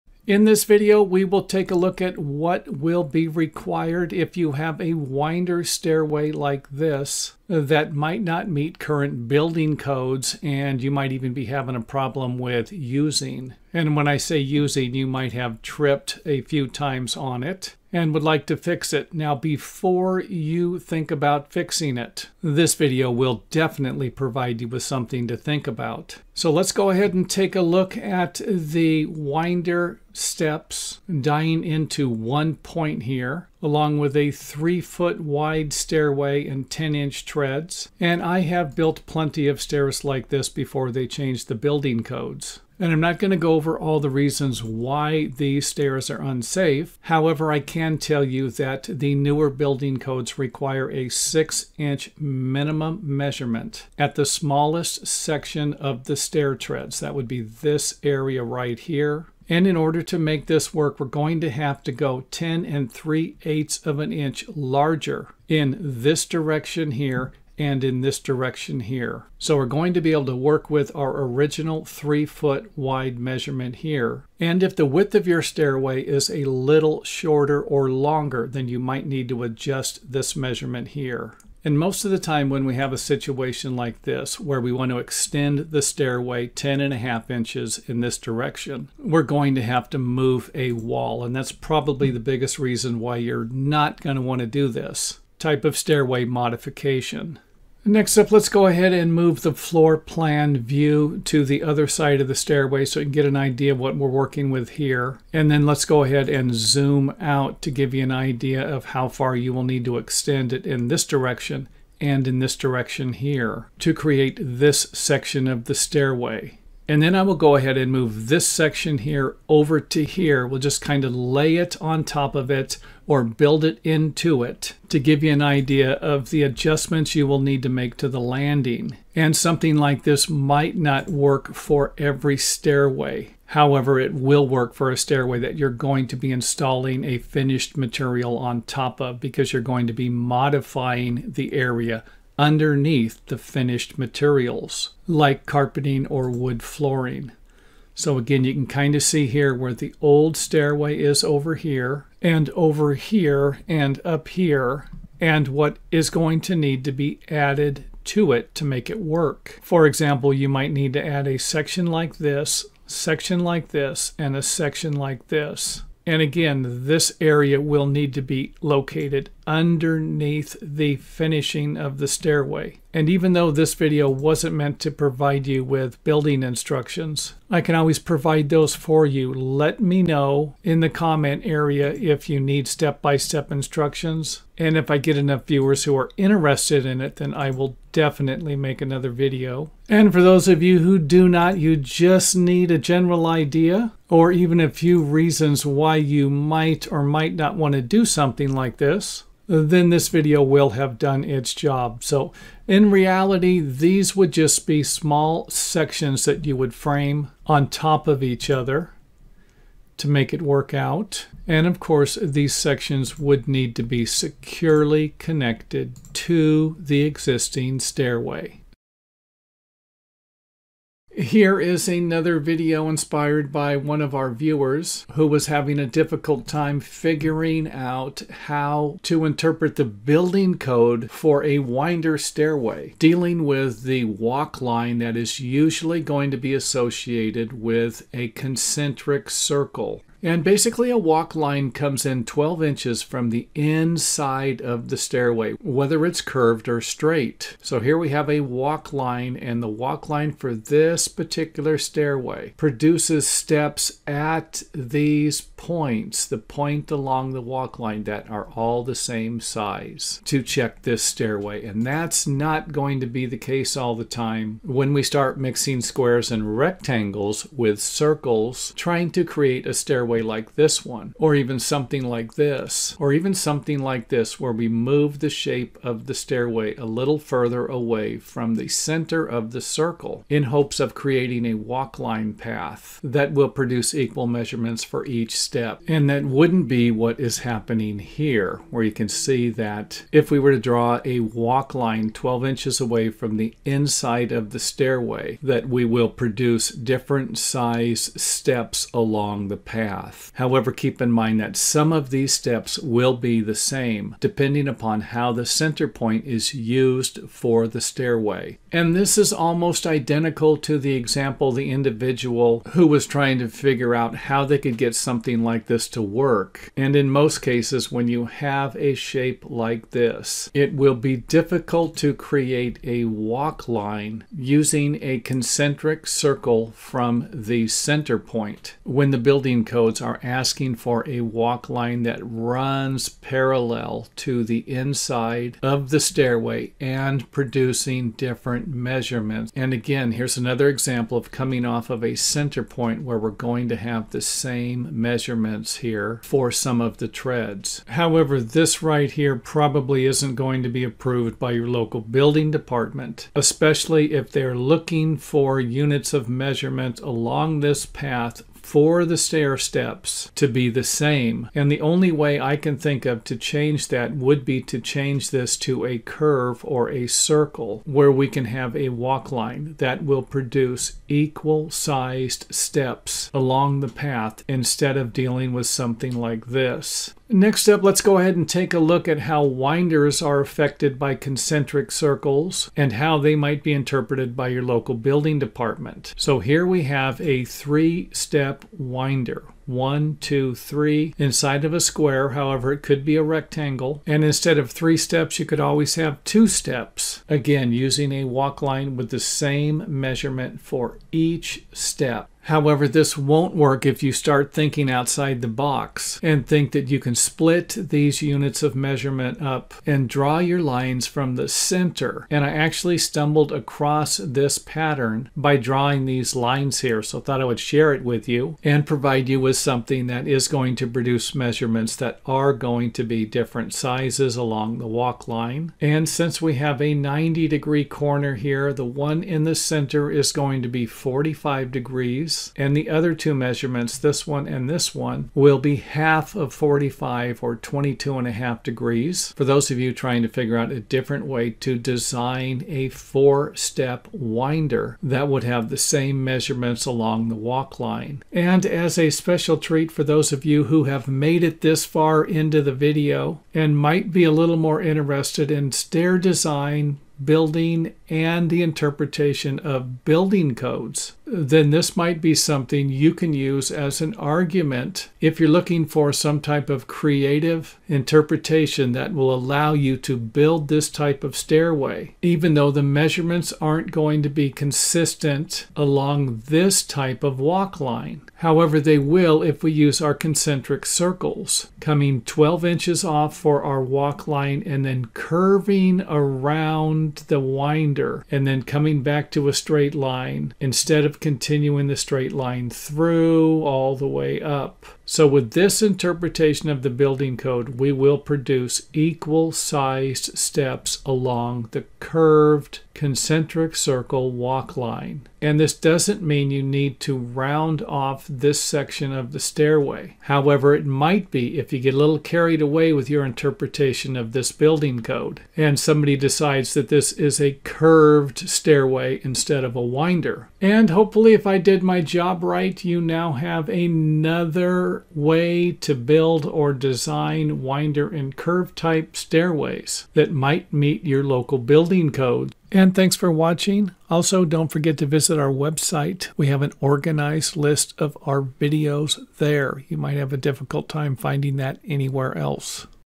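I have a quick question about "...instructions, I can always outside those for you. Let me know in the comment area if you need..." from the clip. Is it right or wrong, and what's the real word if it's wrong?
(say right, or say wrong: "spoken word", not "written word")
wrong: "provide", not "outside".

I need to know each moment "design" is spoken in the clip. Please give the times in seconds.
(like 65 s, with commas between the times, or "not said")
441 s, 456 s, 526 s.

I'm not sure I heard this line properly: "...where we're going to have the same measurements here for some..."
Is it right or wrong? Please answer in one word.
right.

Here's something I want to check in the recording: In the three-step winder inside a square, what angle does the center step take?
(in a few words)
45 degrees.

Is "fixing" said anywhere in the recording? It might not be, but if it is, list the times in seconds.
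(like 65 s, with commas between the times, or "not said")
21 s.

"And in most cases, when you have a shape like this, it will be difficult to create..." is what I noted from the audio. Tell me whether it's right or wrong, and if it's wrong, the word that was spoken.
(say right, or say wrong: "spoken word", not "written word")
right.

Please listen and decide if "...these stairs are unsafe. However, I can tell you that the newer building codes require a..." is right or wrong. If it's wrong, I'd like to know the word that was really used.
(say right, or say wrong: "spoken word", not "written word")
right.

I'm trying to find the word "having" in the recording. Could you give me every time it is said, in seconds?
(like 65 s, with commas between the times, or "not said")
11 s, 225 s.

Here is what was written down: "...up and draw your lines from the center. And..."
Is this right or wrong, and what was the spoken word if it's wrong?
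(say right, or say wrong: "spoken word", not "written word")
right.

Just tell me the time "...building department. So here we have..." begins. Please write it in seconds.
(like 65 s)
384 s.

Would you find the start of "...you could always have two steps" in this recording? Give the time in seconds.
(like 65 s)
395 s.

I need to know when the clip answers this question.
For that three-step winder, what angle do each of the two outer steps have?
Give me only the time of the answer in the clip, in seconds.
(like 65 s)
437 s.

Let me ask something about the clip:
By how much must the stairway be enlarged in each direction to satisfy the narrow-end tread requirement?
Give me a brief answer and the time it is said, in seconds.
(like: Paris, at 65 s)
10 3/8 inches, at 62 s.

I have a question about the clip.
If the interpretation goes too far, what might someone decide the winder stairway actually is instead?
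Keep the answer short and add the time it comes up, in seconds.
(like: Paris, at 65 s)
A curved stairway, at 517 s.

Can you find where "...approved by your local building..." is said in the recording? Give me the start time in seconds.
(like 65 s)
350 s.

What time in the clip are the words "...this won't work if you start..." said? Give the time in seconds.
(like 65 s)
402 s.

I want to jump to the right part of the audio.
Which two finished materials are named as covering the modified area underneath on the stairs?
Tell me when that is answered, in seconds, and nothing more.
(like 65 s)
145 s.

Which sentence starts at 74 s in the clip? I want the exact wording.
And if the width of your stairway is a little shorter or longer, then you might need to adjust this measurement here.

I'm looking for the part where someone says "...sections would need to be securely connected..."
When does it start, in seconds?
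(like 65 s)
212 s.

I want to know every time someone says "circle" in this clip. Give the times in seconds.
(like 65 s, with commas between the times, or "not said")
239 s, 267 s, 279 s, 326 s, 367 s, 381 s, 480 s, 503 s.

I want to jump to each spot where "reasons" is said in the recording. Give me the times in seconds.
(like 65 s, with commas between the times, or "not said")
44 s, 92 s, 195 s.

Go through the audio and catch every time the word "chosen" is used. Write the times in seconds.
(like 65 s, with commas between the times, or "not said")
not said.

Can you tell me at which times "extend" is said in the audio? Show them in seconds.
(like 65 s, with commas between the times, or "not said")
84 s, 109 s.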